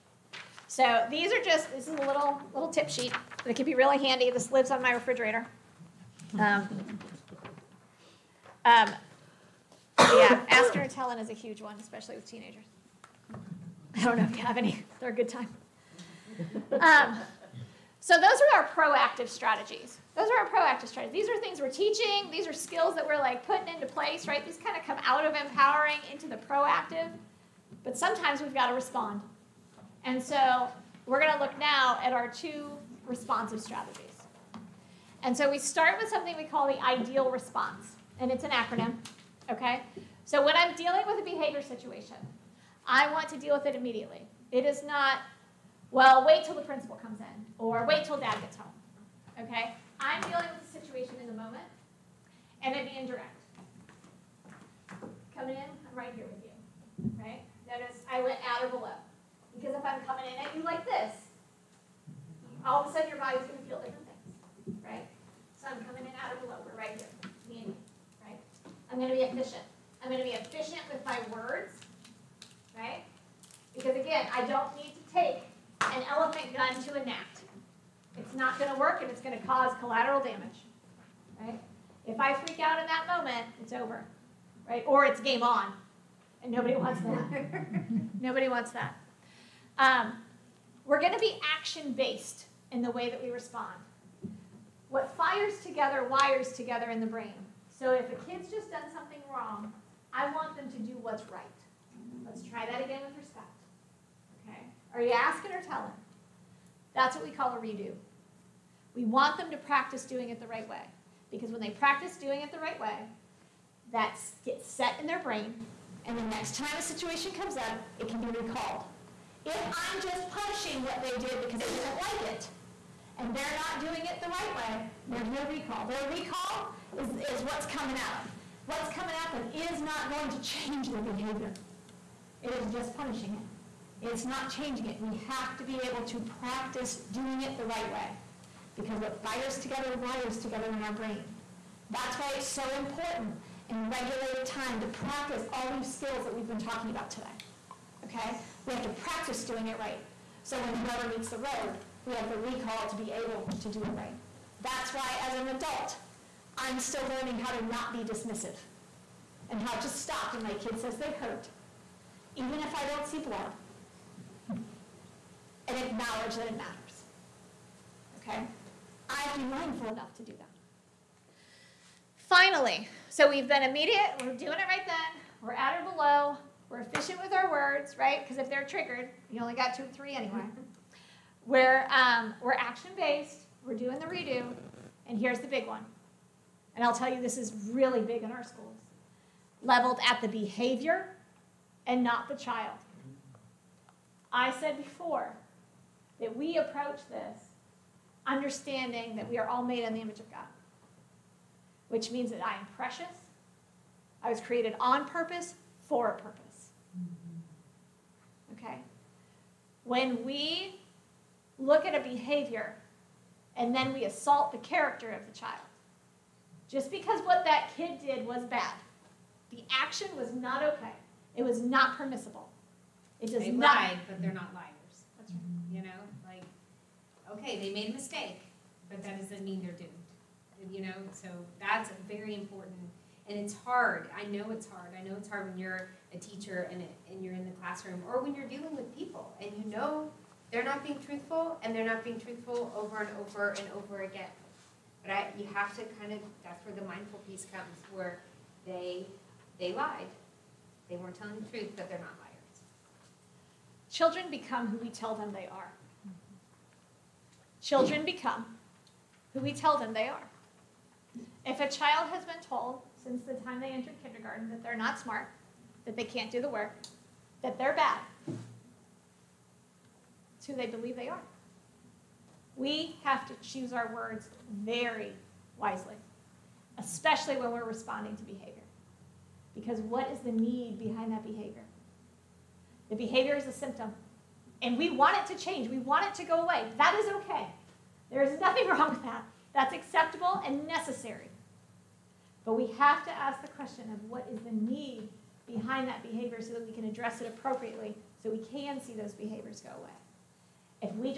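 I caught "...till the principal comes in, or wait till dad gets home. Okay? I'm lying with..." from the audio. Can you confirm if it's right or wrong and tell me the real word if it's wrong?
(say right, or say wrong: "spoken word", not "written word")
wrong: "dealing", not "lying".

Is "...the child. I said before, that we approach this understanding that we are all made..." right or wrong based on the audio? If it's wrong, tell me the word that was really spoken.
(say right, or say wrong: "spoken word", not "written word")
right.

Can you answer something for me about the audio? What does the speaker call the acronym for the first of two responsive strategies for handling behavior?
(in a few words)
ideal response.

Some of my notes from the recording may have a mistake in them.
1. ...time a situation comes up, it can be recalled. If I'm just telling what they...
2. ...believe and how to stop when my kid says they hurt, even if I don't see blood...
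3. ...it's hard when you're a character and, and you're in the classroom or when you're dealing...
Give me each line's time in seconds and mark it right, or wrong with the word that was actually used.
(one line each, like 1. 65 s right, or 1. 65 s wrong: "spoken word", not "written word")
1. 116 s wrong: "punishing", not "telling"
2. 157 s wrong: "dismissive", not "believe"
3. 235 s wrong: "teacher", not "character".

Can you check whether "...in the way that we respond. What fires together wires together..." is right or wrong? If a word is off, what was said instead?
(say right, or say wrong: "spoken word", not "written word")
right.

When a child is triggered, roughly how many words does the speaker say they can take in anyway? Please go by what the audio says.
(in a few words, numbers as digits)
2 or 3.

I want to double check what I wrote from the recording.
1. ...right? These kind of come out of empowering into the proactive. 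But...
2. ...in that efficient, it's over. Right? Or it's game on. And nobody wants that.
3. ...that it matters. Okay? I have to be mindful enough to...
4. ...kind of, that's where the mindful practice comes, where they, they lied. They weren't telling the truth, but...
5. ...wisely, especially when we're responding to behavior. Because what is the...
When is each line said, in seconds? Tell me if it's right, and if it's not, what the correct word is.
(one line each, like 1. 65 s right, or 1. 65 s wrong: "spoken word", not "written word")
1. 24 s right
2. 82 s wrong: "moment", not "efficient"
3. 166 s right
4. 245 s wrong: "piece", not "practice"
5. 275 s right.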